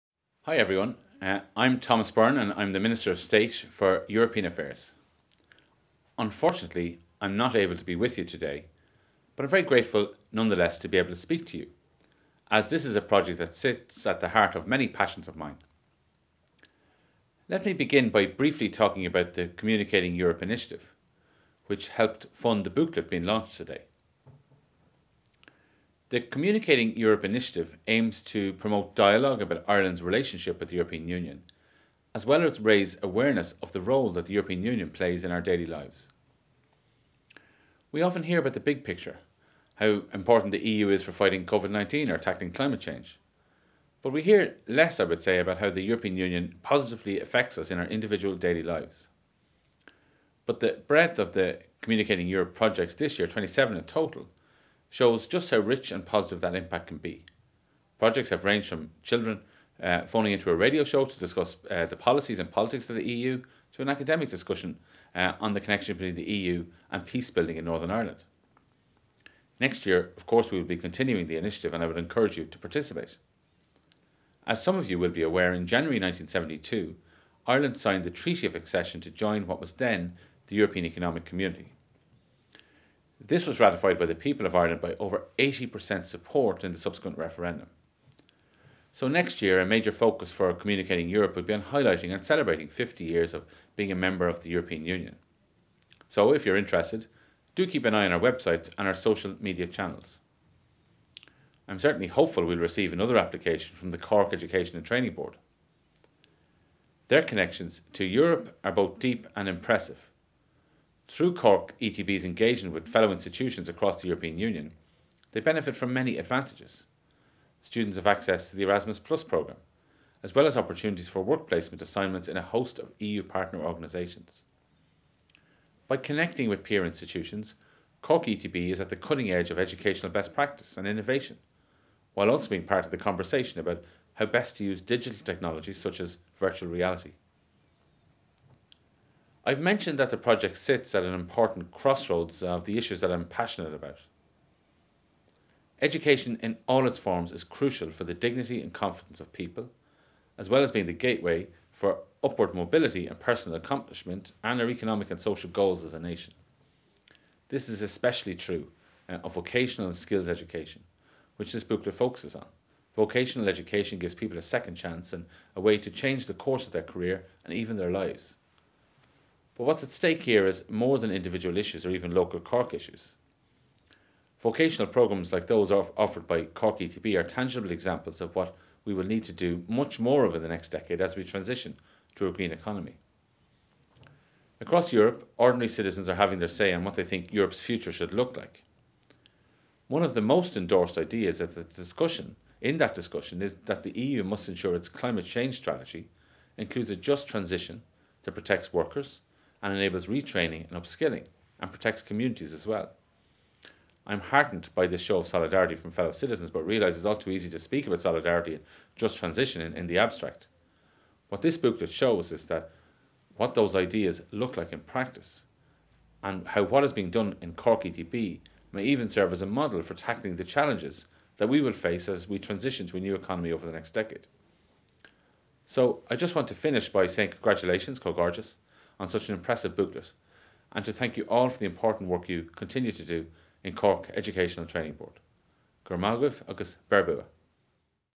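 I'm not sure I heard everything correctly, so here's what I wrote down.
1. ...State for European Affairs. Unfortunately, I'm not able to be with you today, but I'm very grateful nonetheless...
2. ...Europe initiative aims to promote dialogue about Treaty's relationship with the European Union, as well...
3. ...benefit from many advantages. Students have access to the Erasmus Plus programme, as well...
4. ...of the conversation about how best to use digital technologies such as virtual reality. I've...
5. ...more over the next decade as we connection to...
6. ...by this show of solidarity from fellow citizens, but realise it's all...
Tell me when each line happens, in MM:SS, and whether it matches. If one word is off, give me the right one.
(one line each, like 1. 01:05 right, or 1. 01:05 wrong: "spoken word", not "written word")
1. 00:03 right
2. 00:26 wrong: "Ireland", not "Treaty"
3. 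01:55 right
4. 02:12 right
5. 02:59 wrong: "transition", not "connection"
6. 03:24 right.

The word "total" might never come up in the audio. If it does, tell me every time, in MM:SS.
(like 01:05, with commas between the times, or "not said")
00:53.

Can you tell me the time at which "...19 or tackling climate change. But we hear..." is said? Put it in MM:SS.
00:41.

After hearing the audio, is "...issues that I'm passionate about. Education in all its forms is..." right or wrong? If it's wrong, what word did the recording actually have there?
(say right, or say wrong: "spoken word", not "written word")
right.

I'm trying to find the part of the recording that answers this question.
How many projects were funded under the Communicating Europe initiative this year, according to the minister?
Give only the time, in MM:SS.
00:53.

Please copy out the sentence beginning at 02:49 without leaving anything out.
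But what's at stake here is more than individual issues or even local Cork issues.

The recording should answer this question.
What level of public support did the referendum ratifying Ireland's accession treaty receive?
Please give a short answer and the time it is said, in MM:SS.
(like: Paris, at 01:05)
Over 80%, at 01:24.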